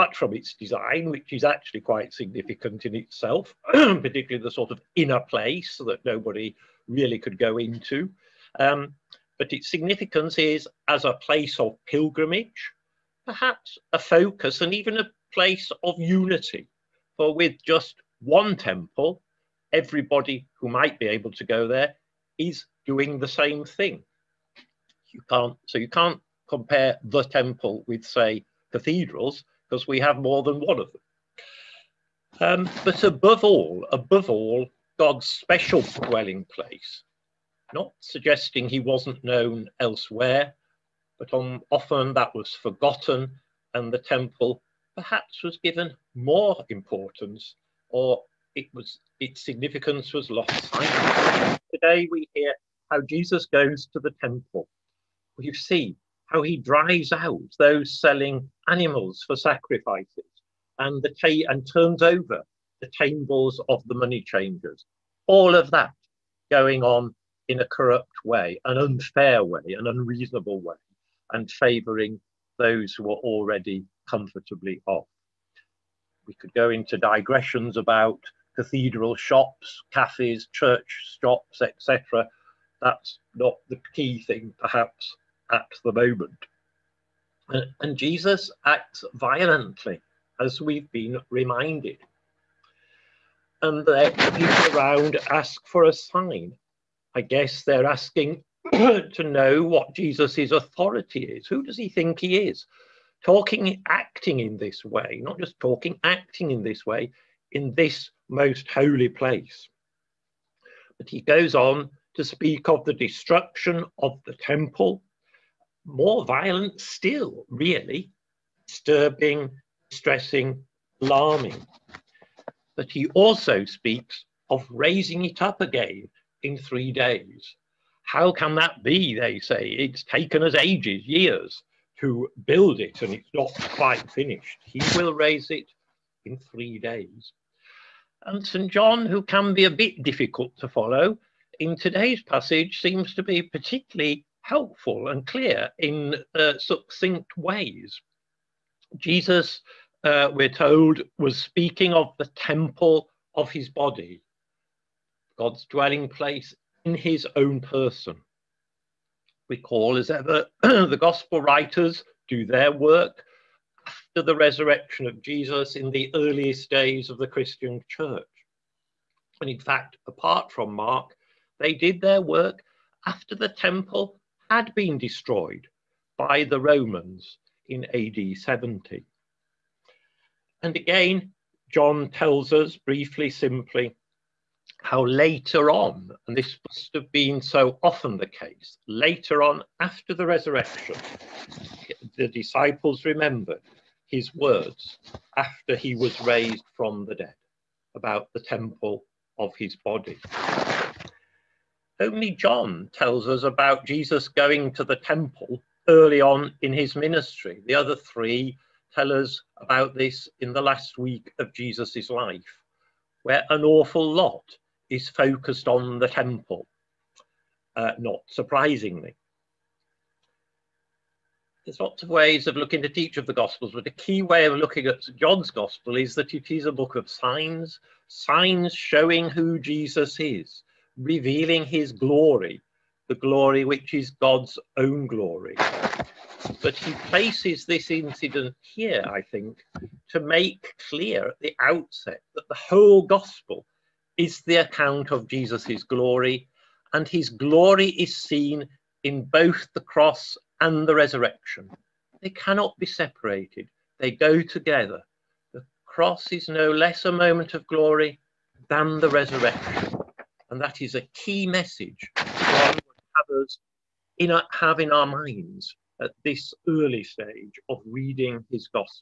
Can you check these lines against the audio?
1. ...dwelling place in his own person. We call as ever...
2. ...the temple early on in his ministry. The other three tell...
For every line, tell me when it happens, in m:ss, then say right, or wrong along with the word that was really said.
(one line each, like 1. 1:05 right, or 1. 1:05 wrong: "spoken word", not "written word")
1. 2:35 right
2. 3:24 right.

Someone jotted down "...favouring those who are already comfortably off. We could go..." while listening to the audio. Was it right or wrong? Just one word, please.
right.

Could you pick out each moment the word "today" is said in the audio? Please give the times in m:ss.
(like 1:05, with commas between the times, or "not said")
0:51, 2:21.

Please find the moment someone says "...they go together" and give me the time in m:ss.
4:13.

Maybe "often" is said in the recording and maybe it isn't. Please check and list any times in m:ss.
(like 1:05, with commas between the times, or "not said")
0:41, 3:07.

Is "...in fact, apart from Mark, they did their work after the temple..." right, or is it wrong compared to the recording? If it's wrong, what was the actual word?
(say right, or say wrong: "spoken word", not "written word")
right.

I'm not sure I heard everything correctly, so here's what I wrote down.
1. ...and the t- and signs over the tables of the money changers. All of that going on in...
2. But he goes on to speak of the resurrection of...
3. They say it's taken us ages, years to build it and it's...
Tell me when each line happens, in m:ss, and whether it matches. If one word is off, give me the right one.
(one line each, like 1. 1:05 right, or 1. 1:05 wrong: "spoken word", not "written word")
1. 1:00 wrong: "turns", not "signs"
2. 1:50 wrong: "destruction", not "resurrection"
3. 2:09 right.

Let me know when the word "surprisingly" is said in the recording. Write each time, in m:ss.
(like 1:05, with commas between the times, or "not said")
3:38.